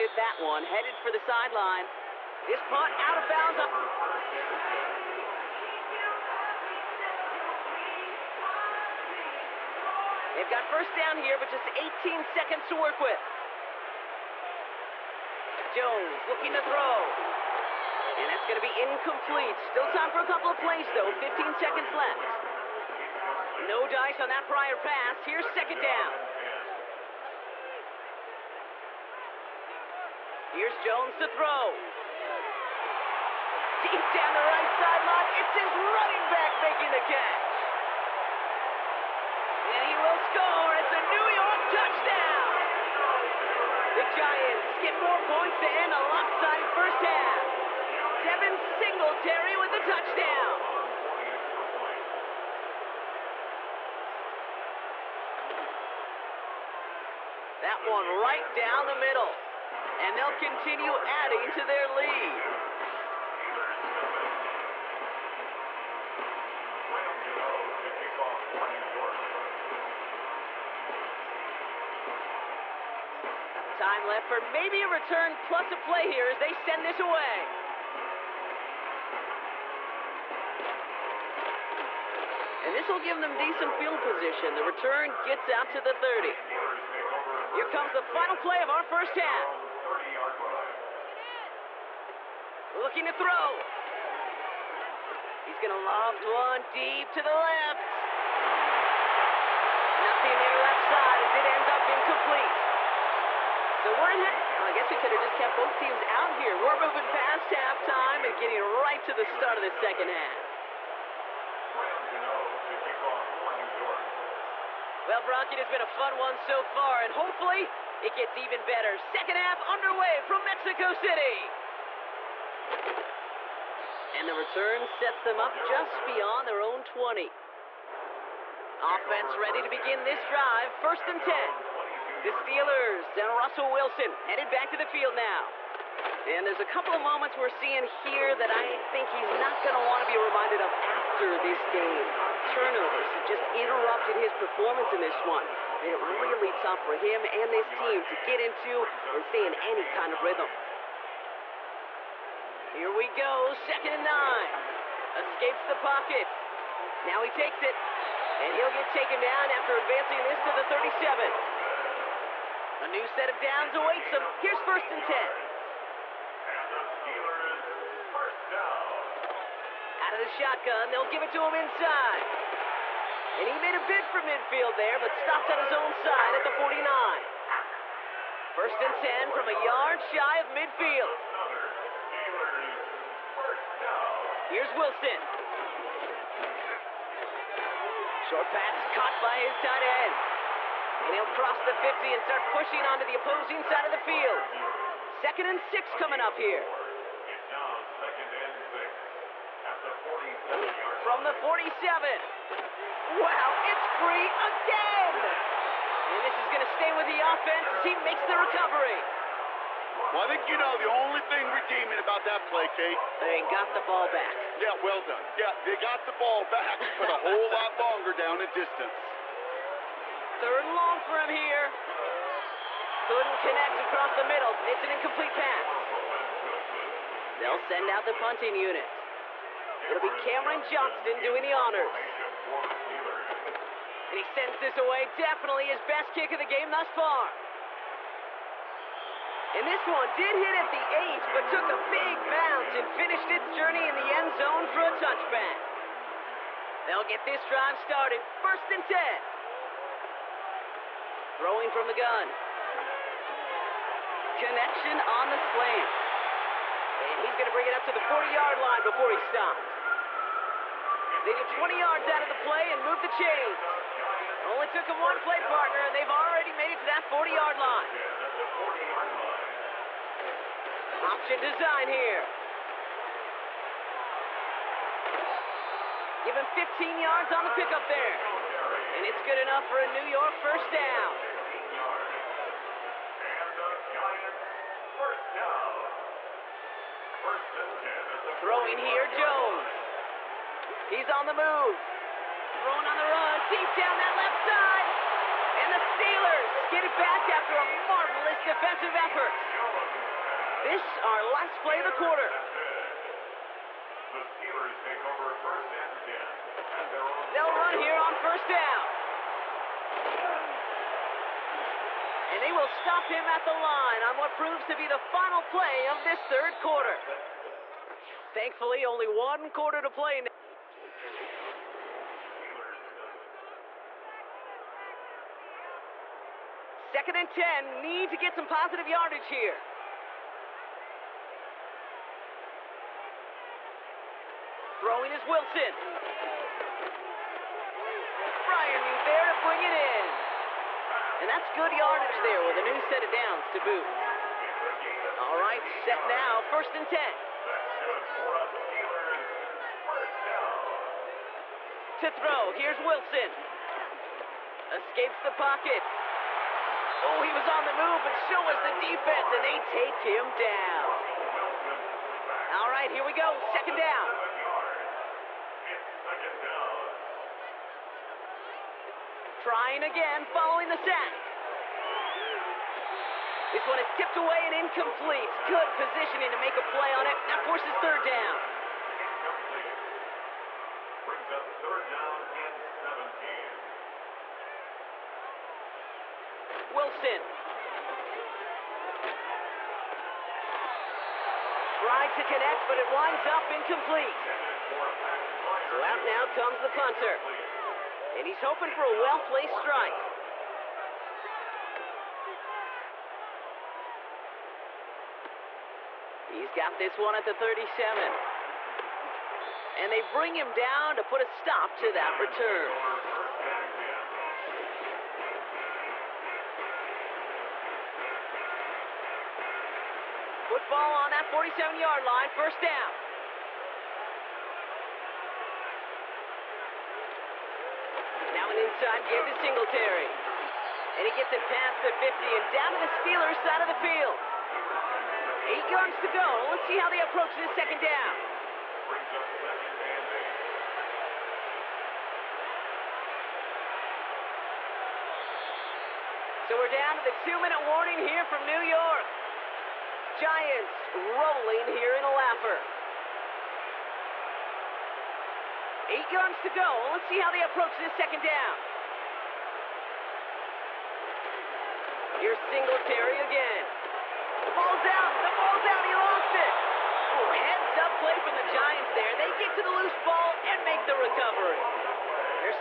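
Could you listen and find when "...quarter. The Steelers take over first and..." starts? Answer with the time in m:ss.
5:01.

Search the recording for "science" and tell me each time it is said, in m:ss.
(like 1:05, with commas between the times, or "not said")
not said.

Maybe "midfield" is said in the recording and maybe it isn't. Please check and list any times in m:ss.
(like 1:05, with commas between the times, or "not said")
2:54, 3:00.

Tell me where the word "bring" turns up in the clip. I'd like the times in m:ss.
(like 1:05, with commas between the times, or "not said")
4:17, 6:21, 6:50.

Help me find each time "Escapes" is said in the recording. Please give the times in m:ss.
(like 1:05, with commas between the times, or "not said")
2:35, 5:54.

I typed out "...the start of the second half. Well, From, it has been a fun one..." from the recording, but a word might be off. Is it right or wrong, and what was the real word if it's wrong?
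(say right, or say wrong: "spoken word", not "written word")
wrong: "Brock", not "From".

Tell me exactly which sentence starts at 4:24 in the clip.
Only took him one play partner, and they've already made it to that 40-yard line.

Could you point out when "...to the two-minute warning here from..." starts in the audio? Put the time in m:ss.
7:26.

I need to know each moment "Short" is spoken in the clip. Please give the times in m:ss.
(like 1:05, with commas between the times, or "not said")
3:08.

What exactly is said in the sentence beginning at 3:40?
Third and long for him here.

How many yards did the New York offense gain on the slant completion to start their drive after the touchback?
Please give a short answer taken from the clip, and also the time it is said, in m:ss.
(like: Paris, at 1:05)
20, at 4:21.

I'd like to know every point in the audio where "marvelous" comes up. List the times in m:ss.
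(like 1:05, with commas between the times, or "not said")
4:57.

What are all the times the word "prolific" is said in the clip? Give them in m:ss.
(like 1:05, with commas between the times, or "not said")
not said.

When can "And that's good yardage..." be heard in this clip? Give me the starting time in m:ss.
5:41.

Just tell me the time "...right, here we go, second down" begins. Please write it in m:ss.
6:02.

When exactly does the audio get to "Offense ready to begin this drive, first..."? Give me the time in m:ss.
2:08.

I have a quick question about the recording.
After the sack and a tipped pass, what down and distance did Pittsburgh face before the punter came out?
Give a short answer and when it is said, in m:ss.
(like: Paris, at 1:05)
Third and 17, at 6:21.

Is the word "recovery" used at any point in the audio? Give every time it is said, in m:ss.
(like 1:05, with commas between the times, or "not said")
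3:28, 7:51.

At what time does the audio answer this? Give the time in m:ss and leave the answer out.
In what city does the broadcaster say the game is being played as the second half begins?
2:00.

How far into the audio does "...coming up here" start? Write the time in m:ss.
3:15.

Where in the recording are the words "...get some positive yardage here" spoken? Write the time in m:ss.
5:28.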